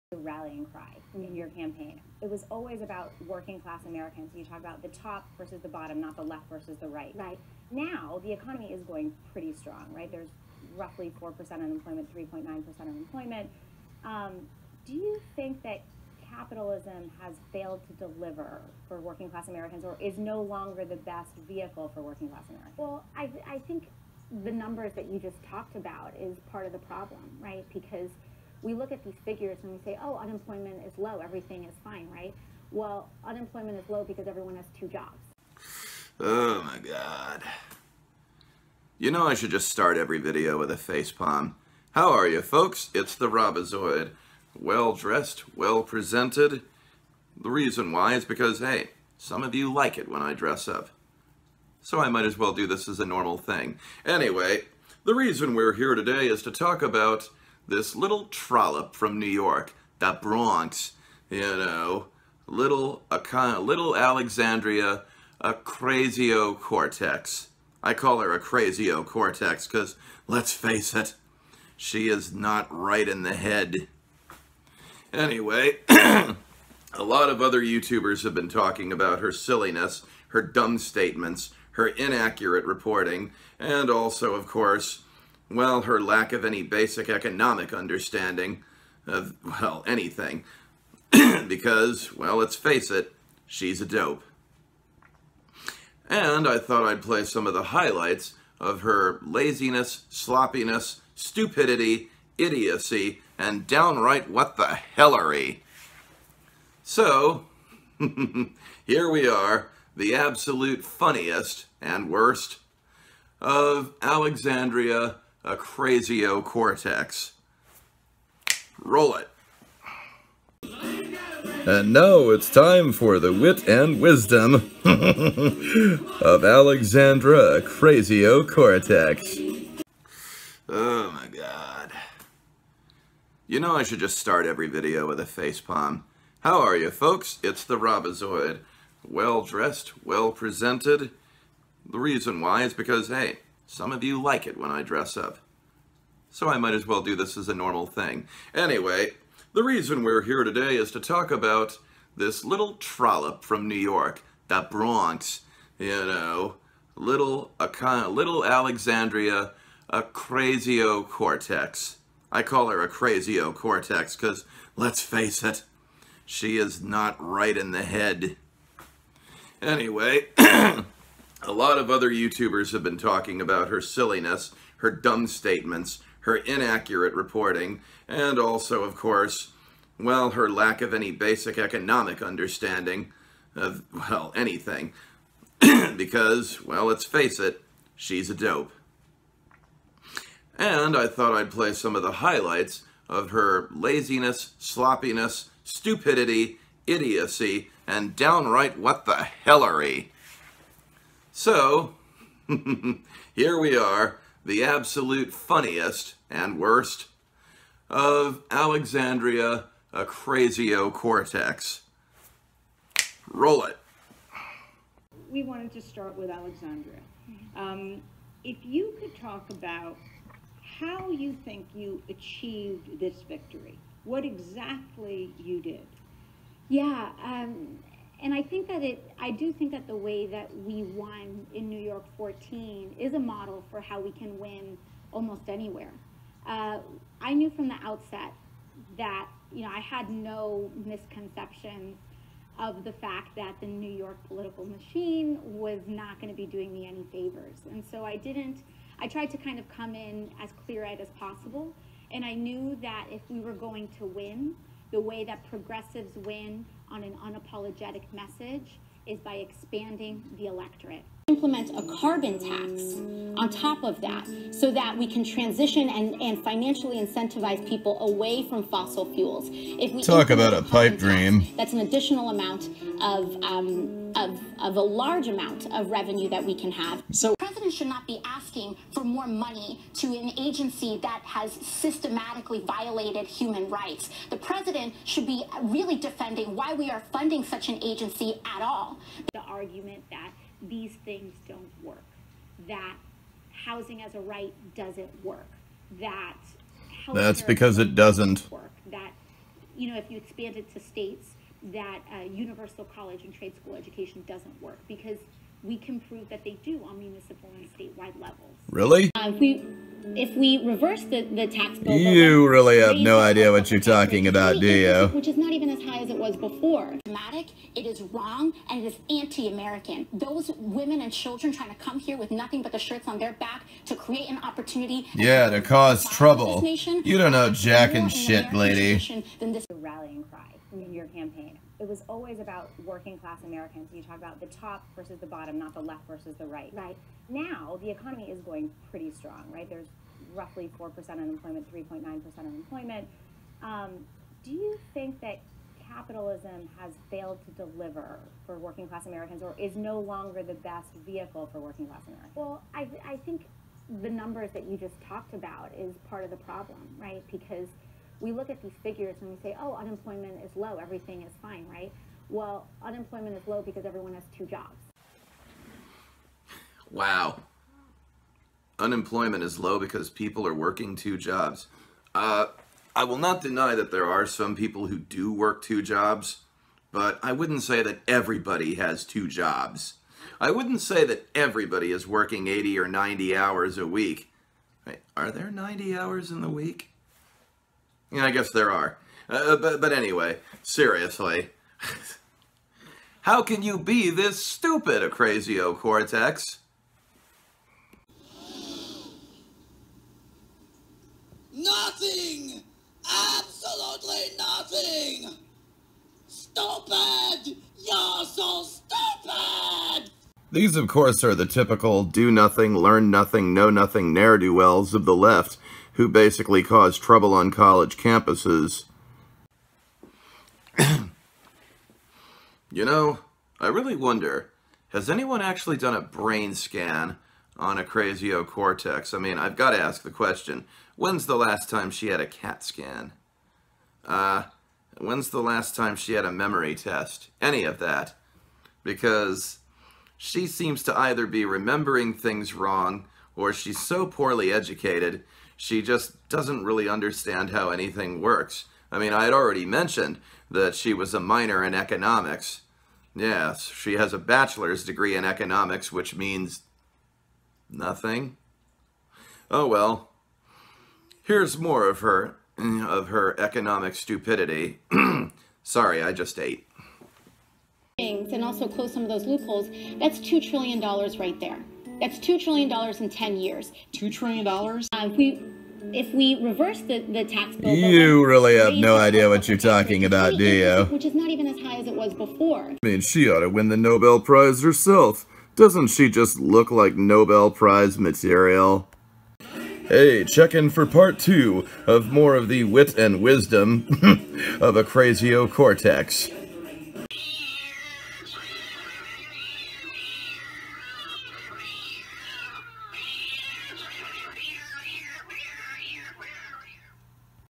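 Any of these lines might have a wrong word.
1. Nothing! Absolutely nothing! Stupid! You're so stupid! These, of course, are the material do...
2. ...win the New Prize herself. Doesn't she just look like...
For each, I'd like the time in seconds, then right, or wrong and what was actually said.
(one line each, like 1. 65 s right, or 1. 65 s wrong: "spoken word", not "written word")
1. 401 s wrong: "typical", not "material"
2. 483 s wrong: "Nobel", not "New".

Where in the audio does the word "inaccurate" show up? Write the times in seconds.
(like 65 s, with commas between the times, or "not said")
81 s, 176 s.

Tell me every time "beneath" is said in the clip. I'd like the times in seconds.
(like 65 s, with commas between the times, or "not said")
not said.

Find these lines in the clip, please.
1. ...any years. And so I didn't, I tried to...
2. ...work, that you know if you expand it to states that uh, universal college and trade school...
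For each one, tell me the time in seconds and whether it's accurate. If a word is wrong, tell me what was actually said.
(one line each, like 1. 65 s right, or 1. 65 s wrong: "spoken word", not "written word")
1. 246 s wrong: "favors", not "years"
2. 298 s right.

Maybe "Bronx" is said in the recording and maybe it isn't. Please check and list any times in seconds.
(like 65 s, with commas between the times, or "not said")
60 s, 154 s.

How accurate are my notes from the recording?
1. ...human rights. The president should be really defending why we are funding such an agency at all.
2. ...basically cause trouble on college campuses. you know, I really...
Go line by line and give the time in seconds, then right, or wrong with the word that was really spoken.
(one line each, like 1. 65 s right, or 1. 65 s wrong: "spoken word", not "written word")
1. 283 s right
2. 416 s right.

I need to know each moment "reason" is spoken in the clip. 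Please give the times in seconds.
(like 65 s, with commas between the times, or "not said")
47 s, 55 s, 141 s, 149 s.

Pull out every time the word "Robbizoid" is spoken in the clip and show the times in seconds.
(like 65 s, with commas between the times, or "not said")
43 s, 137 s.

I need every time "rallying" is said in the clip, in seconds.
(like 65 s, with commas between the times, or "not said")
0 s, 329 s.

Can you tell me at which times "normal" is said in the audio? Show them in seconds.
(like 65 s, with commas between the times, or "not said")
53 s, 147 s.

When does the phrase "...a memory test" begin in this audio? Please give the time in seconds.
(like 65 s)
436 s.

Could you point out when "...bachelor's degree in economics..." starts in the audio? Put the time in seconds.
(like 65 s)
454 s.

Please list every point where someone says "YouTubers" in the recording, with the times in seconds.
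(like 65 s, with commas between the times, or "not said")
77 s, 172 s.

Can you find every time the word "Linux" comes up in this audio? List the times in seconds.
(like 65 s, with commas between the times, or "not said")
not said.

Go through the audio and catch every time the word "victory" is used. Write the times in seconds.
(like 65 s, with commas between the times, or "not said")
223 s.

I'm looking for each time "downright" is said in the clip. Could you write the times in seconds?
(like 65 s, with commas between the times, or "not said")
103 s, 198 s.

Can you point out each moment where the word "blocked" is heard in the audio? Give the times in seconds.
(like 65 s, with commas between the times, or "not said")
not said.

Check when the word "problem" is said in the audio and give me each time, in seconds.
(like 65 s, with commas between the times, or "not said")
26 s, 356 s.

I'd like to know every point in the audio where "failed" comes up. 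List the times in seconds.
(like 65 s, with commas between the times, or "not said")
17 s, 347 s.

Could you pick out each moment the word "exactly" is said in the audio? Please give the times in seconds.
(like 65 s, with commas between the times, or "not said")
224 s.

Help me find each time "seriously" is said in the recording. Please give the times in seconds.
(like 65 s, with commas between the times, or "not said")
390 s.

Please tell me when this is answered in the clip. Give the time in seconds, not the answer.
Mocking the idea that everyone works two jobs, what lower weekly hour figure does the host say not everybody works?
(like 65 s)
382 s.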